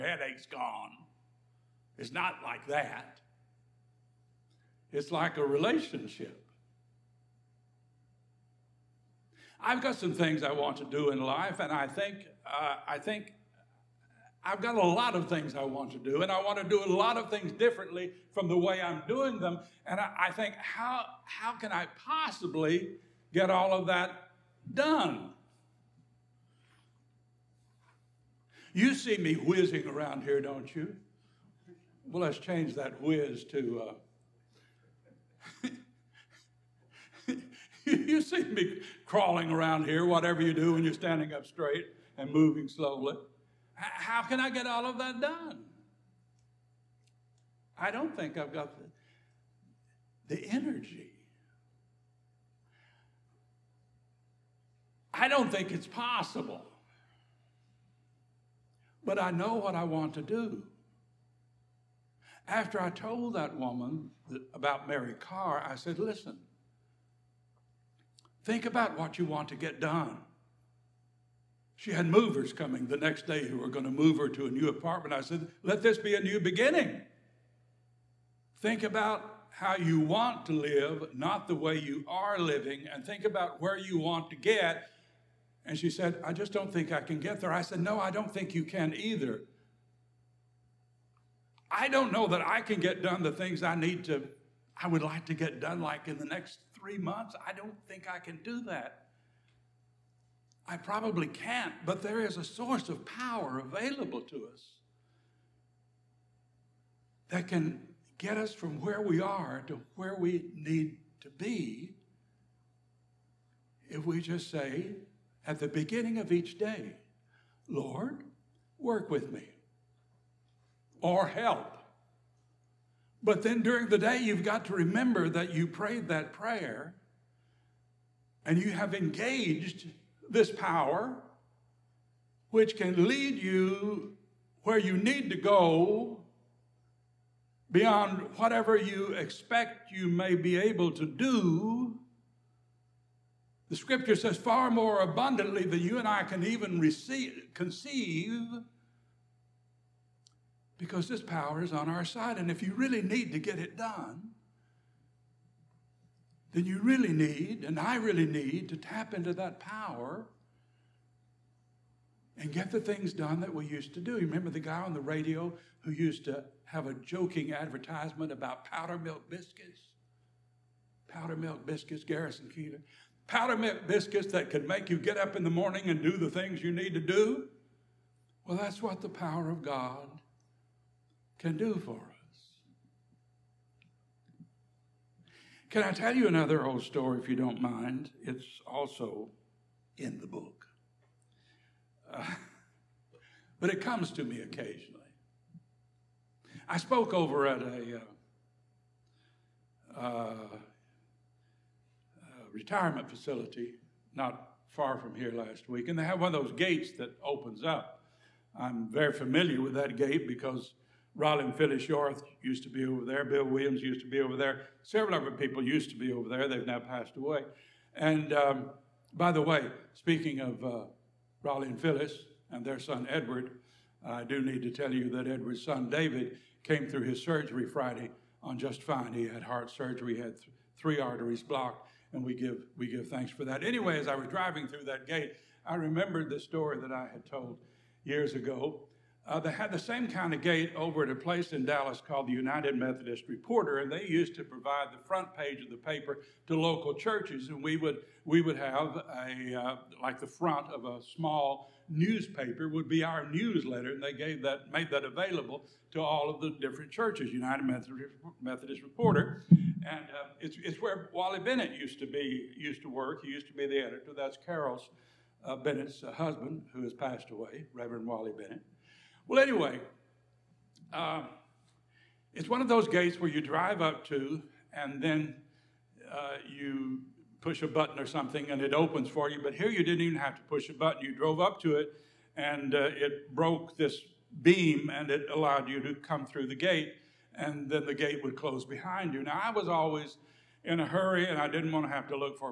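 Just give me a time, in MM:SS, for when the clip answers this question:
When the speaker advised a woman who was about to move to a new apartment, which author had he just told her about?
01:04.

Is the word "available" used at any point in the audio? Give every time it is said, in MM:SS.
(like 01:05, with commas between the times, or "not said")
01:43, 04:15.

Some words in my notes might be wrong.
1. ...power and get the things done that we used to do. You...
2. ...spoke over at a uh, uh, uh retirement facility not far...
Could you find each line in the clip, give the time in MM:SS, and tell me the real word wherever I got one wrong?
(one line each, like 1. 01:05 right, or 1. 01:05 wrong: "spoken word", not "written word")
1. 02:39 right
2. 03:16 right.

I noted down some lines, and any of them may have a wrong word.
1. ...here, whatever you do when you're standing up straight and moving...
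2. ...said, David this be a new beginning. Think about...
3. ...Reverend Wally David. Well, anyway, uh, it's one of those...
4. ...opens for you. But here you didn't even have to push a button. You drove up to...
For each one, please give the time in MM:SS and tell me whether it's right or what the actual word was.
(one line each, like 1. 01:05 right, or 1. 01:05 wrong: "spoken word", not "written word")
1. 00:39 right
2. 01:15 wrong: "Let", not "David"
3. 04:27 wrong: "Bennett", not "David"
4. 04:38 right.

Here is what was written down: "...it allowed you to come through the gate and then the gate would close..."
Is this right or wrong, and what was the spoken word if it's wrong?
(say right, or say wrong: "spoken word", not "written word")
right.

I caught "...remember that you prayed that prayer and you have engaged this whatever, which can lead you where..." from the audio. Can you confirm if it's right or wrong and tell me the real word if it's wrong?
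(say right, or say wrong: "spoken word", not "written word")
wrong: "power", not "whatever".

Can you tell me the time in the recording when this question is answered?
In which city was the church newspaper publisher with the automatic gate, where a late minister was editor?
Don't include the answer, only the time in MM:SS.
04:01.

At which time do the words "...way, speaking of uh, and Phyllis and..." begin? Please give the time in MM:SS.
03:39.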